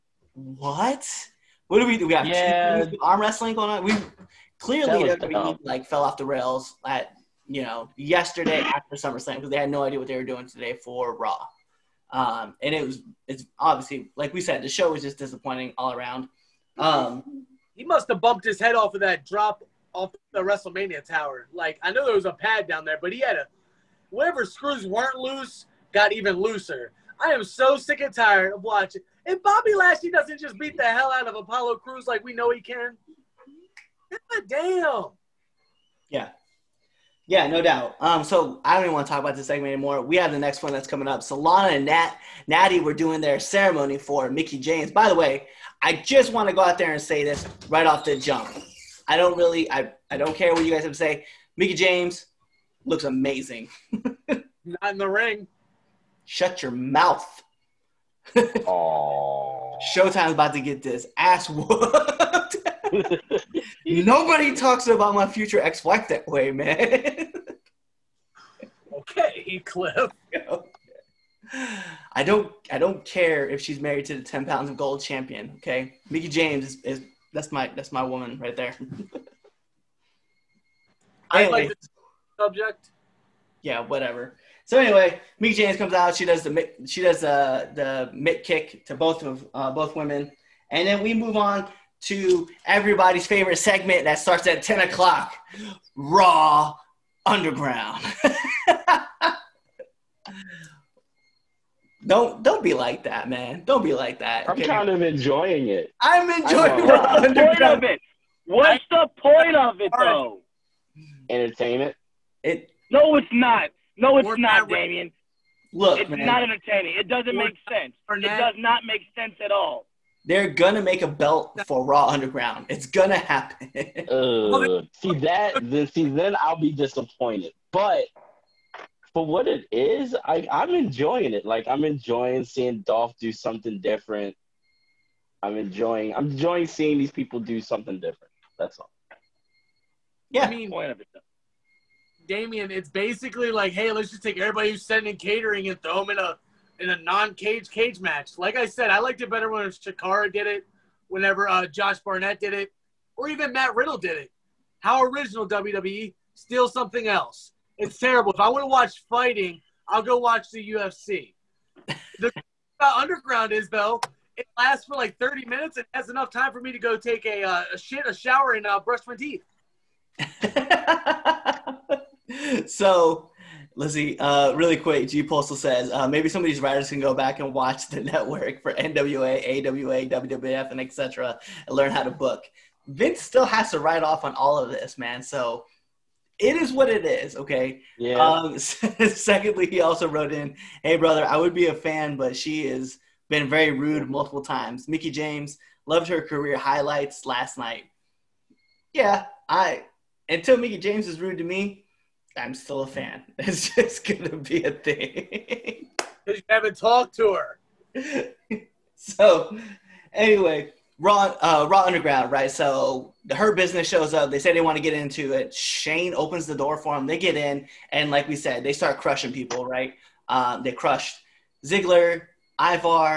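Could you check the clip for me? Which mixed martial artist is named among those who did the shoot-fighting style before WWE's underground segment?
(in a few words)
Josh Barnett.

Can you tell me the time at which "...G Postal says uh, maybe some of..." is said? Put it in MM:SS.
02:55.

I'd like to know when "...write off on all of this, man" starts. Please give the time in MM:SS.
03:03.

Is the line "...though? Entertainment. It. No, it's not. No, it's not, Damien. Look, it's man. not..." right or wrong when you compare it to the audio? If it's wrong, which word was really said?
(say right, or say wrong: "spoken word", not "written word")
right.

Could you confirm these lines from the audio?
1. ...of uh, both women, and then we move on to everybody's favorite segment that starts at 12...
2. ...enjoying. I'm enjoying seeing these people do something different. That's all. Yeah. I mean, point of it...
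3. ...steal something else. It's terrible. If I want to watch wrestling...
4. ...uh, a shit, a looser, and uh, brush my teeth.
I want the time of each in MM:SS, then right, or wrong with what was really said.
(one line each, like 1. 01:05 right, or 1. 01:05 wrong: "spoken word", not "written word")
1. 01:29 wrong: "10", not "12"
2. 02:15 right
3. 02:36 wrong: "fighting", not "wrestling"
4. 02:47 wrong: "shower", not "looser".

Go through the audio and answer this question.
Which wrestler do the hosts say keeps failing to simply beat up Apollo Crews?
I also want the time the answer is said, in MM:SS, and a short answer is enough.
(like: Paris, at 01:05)
Bobby Lashley, at 00:29.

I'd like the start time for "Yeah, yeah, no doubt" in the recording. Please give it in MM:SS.
00:36.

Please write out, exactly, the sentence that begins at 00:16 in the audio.
Um, he must have bumped his head off of that drop off the WrestleMania tower.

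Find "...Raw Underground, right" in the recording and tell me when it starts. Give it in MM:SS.
03:31.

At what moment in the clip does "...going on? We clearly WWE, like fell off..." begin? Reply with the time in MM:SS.
00:03.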